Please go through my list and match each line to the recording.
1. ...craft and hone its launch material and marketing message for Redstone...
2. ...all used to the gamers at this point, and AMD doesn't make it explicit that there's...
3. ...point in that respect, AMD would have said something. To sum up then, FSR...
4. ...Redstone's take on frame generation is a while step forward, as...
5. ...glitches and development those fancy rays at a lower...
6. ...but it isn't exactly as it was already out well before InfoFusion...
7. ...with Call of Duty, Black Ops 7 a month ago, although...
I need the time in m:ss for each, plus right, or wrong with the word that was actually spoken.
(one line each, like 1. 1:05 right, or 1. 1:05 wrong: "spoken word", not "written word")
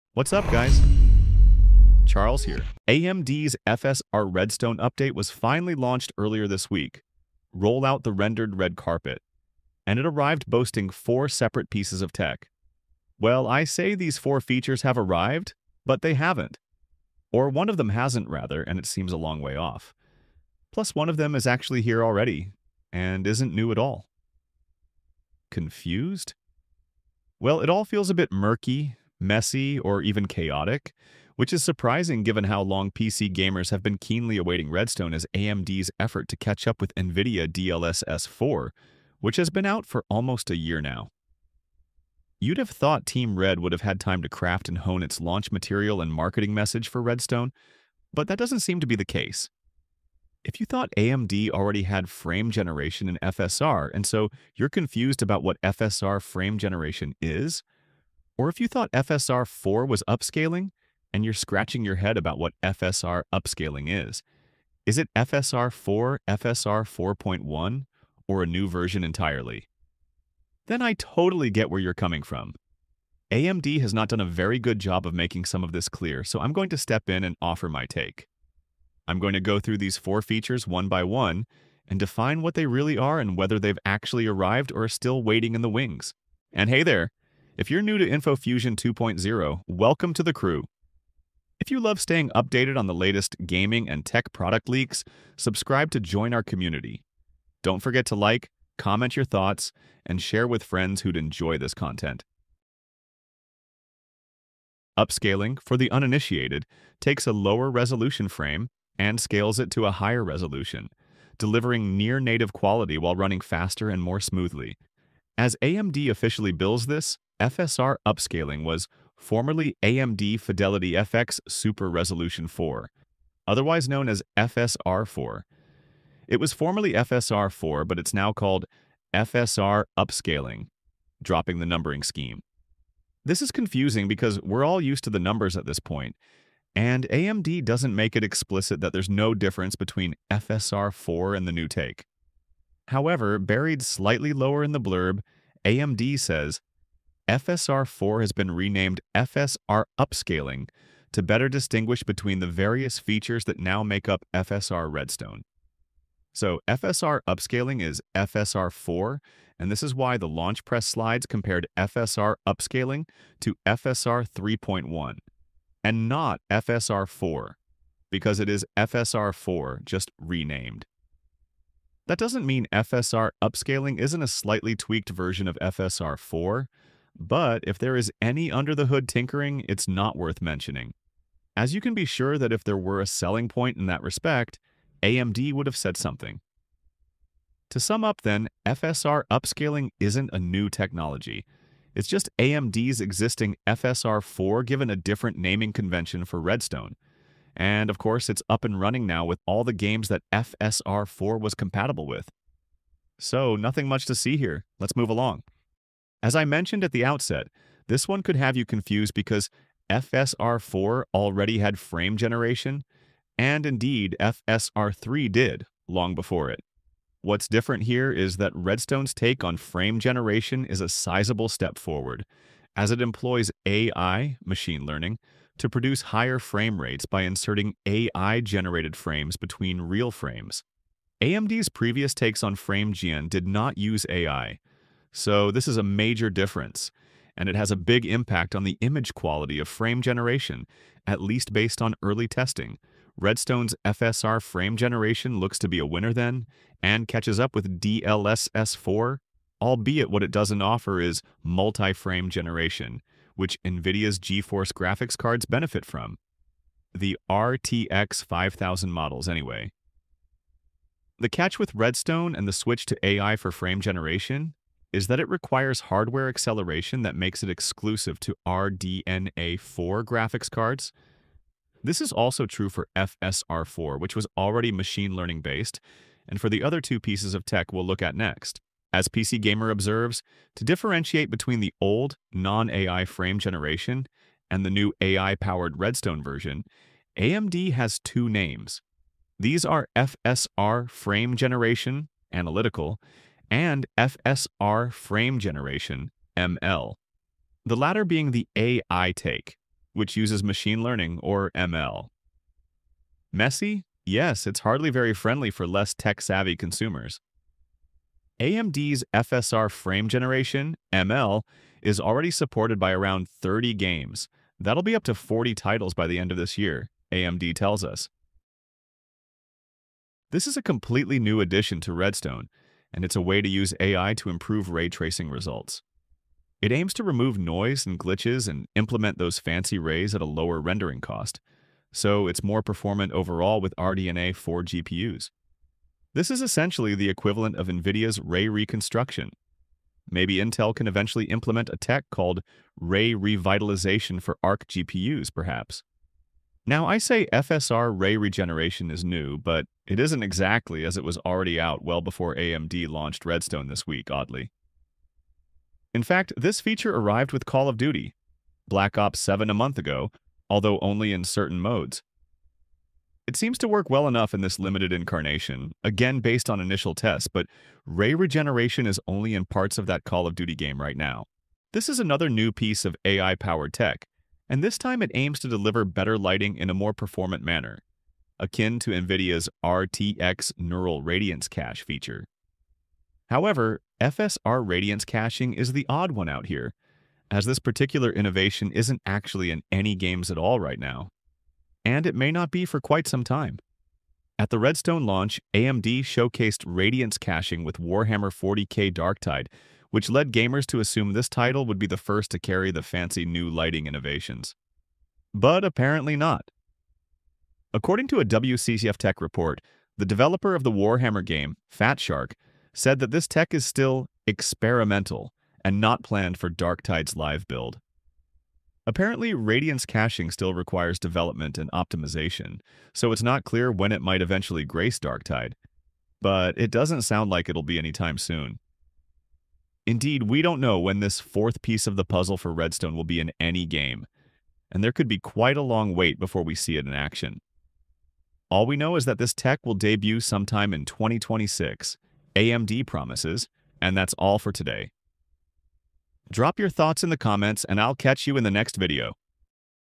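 1. 0:44 right
2. 2:14 wrong: "numbers", not "gamers"
3. 3:03 right
4. 3:38 wrong: "sizable", not "while"
5. 5:27 wrong: "implement", not "development"
6. 5:49 wrong: "AMD", not "InfoFusion"
7. 5:57 right.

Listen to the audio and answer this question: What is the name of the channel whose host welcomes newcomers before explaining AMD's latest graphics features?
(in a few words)
InfoFusion 2.0.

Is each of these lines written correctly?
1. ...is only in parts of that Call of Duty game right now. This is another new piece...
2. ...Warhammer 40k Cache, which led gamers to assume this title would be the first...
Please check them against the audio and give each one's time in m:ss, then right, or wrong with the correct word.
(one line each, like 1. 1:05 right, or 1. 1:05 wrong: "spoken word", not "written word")
1. 6:08 right
2. 6:37 wrong: "Darktide", not "Cache".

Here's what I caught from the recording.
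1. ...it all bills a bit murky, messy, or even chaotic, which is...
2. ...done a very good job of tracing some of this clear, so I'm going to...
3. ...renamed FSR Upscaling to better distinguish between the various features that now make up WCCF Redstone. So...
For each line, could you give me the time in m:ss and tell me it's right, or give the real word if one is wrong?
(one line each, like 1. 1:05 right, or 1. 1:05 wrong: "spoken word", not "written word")
1. 0:27 wrong: "feels", not "bills"
2. 1:14 wrong: "making", not "tracing"
3. 2:28 wrong: "FSR", not "WCCF".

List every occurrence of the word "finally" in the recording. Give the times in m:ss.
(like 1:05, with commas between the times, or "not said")
0:05.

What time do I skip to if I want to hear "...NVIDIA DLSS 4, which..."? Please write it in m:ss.
0:36.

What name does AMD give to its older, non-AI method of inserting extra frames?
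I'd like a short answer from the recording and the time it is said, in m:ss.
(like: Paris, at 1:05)
Analytical, at 4:52.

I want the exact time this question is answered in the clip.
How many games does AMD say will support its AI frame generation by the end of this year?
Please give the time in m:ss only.
5:15.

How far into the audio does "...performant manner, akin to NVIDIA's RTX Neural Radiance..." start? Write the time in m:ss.
6:16.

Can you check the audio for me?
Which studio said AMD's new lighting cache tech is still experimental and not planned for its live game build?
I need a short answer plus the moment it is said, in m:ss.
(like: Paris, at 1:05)
Fat Shark, at 6:51.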